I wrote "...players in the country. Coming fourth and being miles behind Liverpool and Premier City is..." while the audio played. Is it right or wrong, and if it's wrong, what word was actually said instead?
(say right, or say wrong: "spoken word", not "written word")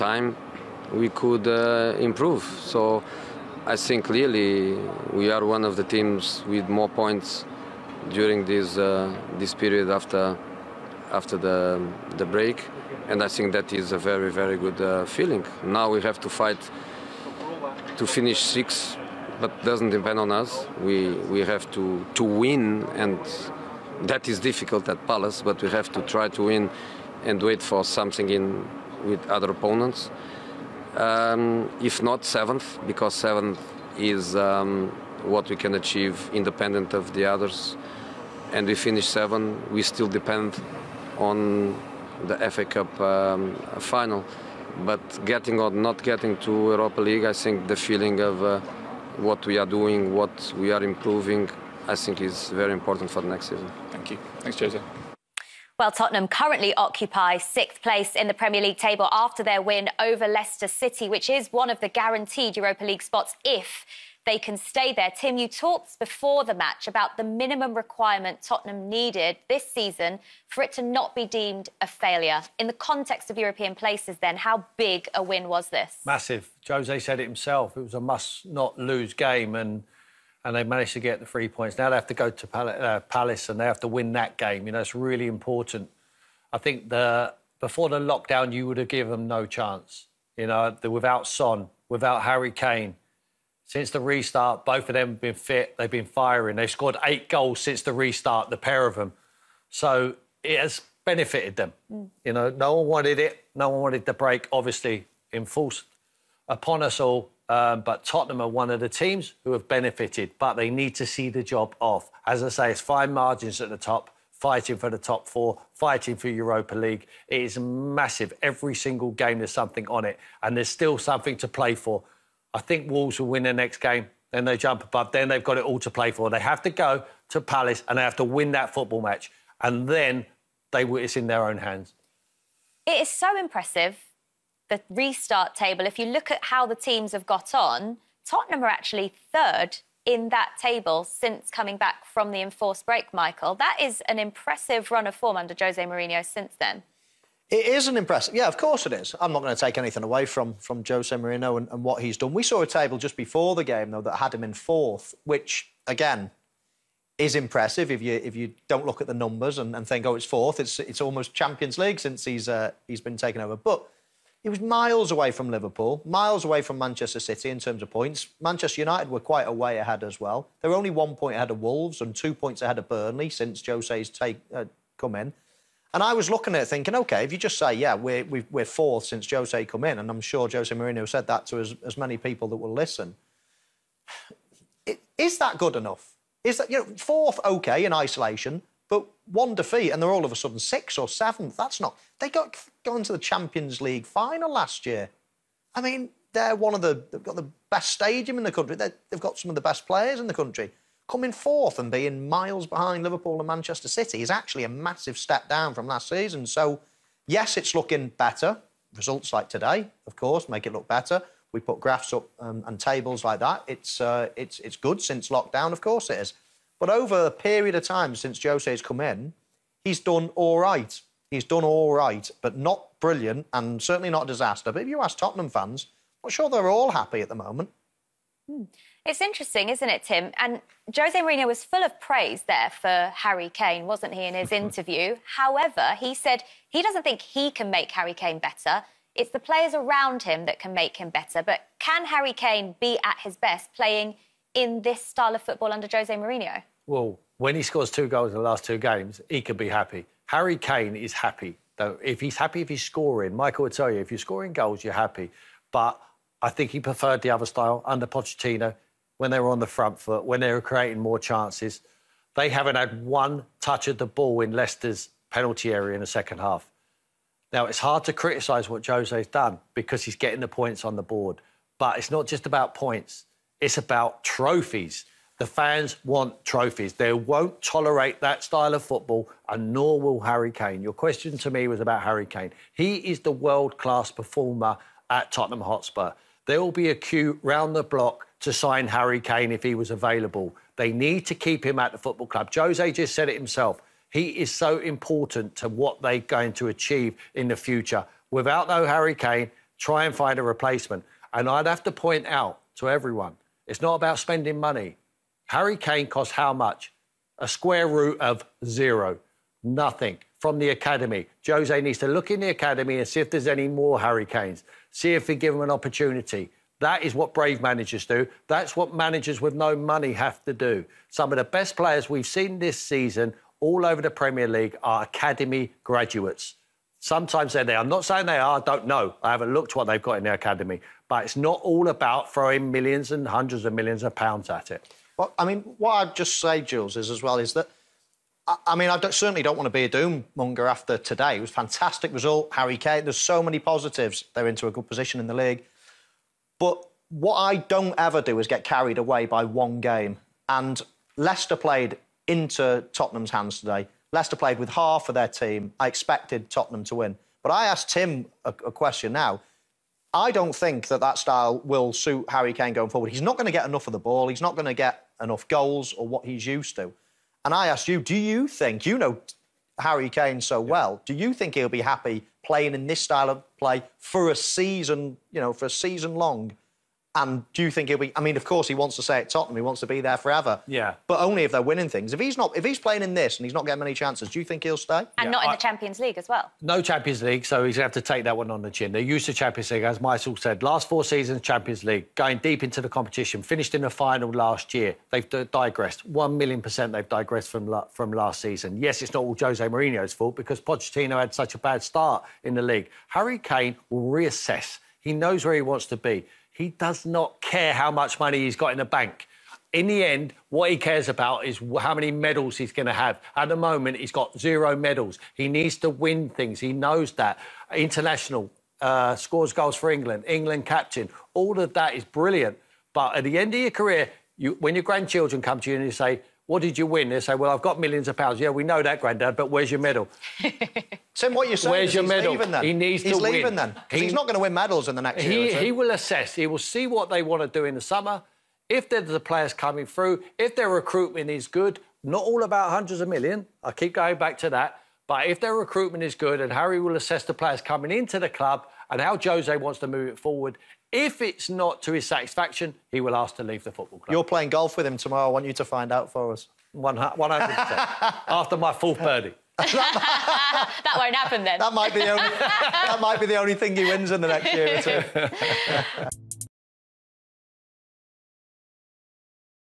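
wrong: "Manchester", not "Premier".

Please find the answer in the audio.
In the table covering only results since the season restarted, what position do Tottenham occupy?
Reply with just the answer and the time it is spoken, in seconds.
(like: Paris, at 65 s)
3rd, at 139 s.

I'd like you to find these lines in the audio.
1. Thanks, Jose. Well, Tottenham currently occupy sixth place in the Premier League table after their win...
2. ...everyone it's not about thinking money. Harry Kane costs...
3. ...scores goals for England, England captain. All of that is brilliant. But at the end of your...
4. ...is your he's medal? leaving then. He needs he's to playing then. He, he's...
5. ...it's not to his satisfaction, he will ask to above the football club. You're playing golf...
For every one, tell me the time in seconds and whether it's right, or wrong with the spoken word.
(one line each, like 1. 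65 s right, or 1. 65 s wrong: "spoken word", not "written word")
1. 54 s right
2. 302 s wrong: "spending", not "thinking"
3. 419 s right
4. 431 s wrong: "leaving", not "playing"
5. 451 s wrong: "leave", not "above".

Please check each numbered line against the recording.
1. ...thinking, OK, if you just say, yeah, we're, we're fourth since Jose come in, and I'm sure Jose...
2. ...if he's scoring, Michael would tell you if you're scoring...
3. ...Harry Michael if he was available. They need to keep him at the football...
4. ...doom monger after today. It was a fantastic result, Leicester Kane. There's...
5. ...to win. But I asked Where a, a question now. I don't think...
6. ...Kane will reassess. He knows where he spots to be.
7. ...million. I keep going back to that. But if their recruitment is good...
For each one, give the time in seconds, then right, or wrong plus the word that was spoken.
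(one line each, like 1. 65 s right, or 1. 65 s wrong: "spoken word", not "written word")
1. 176 s right
2. 252 s right
3. 288 s wrong: "Kane", not "Michael"
4. 339 s wrong: "Harry", not "Leicester"
5. 356 s wrong: "Tim", not "Where"
6. 403 s wrong: "wants", not "spots"
7. 443 s right.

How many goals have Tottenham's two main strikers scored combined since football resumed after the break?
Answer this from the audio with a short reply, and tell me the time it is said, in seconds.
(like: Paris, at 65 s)
8, at 97 s.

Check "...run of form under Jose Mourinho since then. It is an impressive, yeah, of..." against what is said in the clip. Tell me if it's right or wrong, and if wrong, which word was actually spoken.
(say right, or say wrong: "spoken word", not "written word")
right.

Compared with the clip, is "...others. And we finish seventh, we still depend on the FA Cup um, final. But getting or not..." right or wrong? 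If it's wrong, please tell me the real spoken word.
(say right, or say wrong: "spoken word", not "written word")
right.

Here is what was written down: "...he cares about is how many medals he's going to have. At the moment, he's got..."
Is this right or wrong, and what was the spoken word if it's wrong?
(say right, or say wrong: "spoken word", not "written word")
right.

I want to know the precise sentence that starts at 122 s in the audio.
I think Wolves will win their next game, then they jump above, then they've got it all to play for.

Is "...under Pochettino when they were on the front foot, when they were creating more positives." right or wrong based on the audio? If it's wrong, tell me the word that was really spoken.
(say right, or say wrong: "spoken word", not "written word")
wrong: "chances", not "positives".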